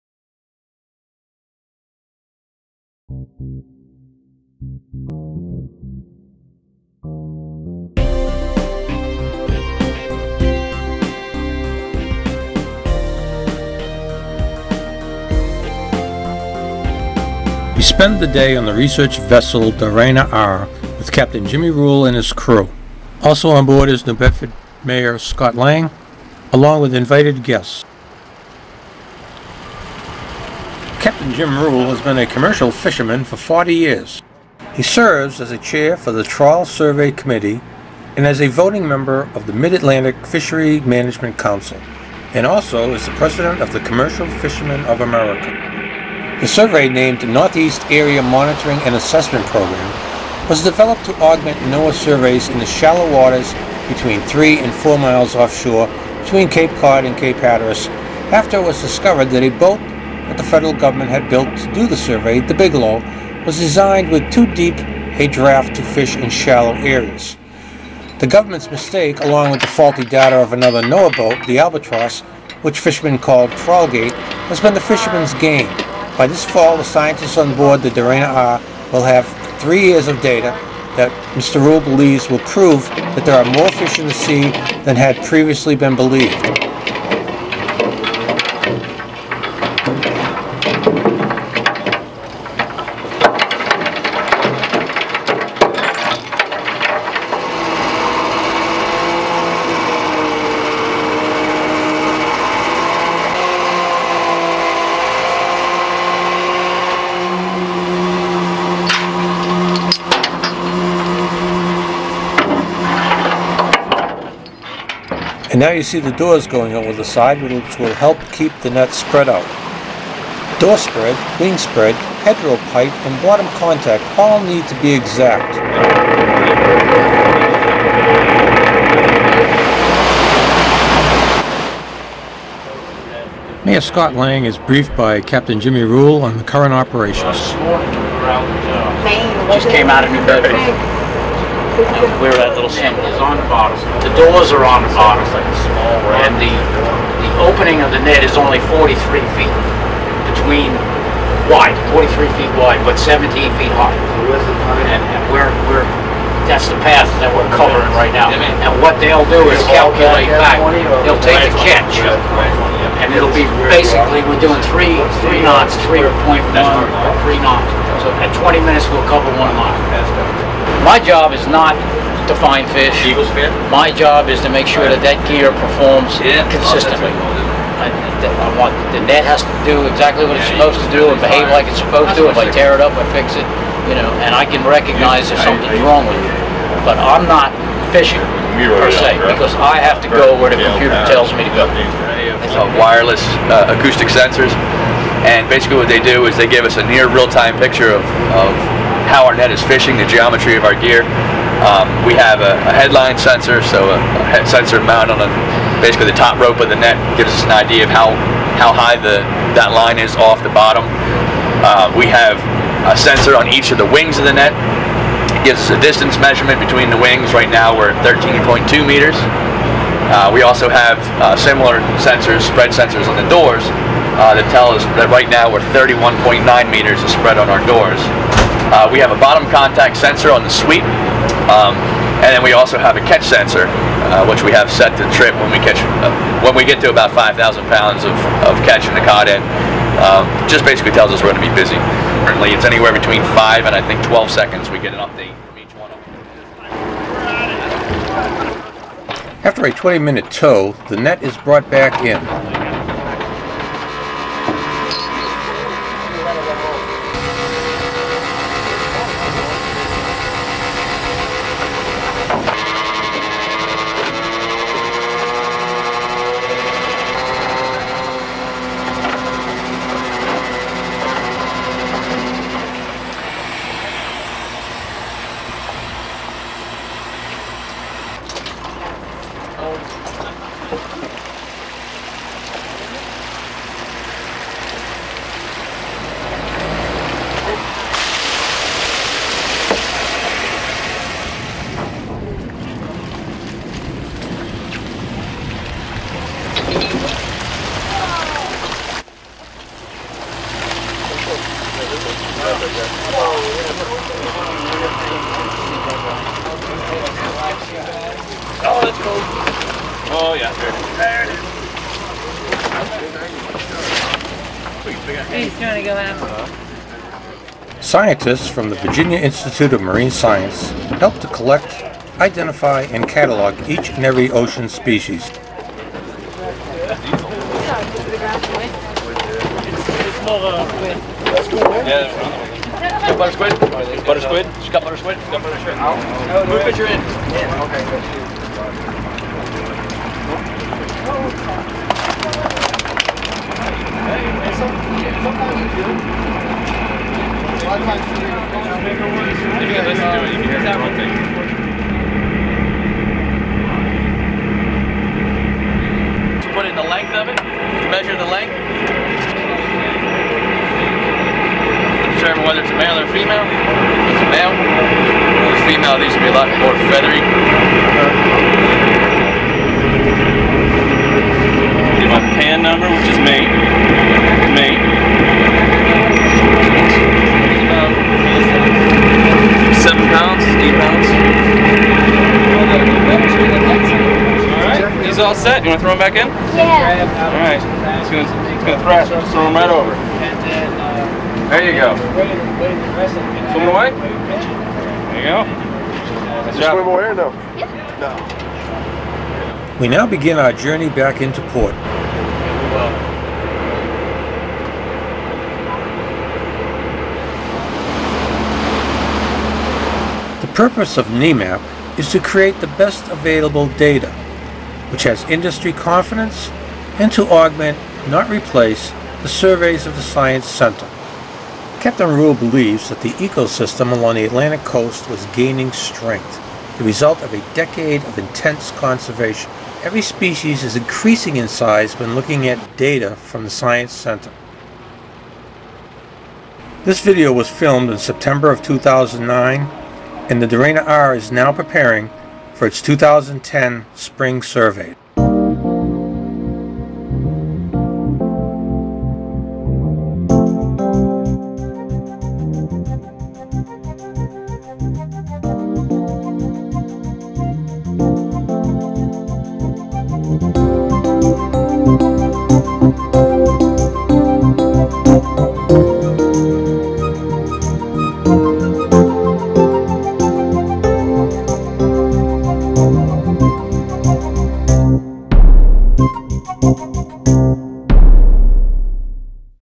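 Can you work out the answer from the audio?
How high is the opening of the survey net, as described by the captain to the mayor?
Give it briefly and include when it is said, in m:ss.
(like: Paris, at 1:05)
17 feet, at 2:32.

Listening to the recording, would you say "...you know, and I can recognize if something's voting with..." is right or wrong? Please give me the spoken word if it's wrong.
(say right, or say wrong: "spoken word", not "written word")
wrong: "wrong", not "voting".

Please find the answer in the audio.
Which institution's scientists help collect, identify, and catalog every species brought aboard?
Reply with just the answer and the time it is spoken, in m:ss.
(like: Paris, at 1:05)
Virginia Institute of Marine Science, at 5:18.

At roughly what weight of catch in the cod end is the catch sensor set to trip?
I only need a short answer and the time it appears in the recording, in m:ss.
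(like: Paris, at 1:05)
5,000 pounds, at 3:57.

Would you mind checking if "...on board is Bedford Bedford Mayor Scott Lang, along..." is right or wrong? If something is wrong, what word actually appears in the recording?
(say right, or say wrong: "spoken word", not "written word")
wrong: "New", not "Bedford".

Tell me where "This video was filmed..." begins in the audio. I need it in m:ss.
7:16.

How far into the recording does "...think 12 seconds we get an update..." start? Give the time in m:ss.
4:03.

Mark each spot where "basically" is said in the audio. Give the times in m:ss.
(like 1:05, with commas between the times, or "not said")
2:43, 3:15, 3:25, 4:00.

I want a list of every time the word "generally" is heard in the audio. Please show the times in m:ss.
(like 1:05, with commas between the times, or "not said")
not said.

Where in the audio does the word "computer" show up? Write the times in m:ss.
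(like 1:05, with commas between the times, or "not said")
3:10.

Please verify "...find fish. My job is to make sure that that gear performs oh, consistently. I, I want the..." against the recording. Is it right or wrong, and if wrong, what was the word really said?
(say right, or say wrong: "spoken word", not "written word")
right.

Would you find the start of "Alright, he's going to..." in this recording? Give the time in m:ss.
6:27.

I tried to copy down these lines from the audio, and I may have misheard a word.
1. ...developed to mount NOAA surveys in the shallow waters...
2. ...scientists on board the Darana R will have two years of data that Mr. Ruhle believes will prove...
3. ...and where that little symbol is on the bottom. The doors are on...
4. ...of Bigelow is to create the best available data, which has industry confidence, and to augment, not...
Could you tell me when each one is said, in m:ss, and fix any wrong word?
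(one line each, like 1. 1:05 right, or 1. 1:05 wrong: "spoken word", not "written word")
1. 0:50 wrong: "augment", not "mount"
2. 1:16 wrong: "three", not "two"
3. 2:21 right
4. 6:50 wrong: "NEAMAP", not "Bigelow".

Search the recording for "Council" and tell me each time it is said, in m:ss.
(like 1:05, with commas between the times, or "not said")
0:41.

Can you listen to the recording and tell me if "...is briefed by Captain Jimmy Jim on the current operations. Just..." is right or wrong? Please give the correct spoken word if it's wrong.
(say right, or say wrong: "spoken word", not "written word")
wrong: "Ruhle", not "Jim".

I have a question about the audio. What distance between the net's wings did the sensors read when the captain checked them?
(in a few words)
13.2 meters.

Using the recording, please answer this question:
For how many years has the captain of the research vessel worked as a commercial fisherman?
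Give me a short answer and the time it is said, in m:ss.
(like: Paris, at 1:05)
40 years, at 0:33.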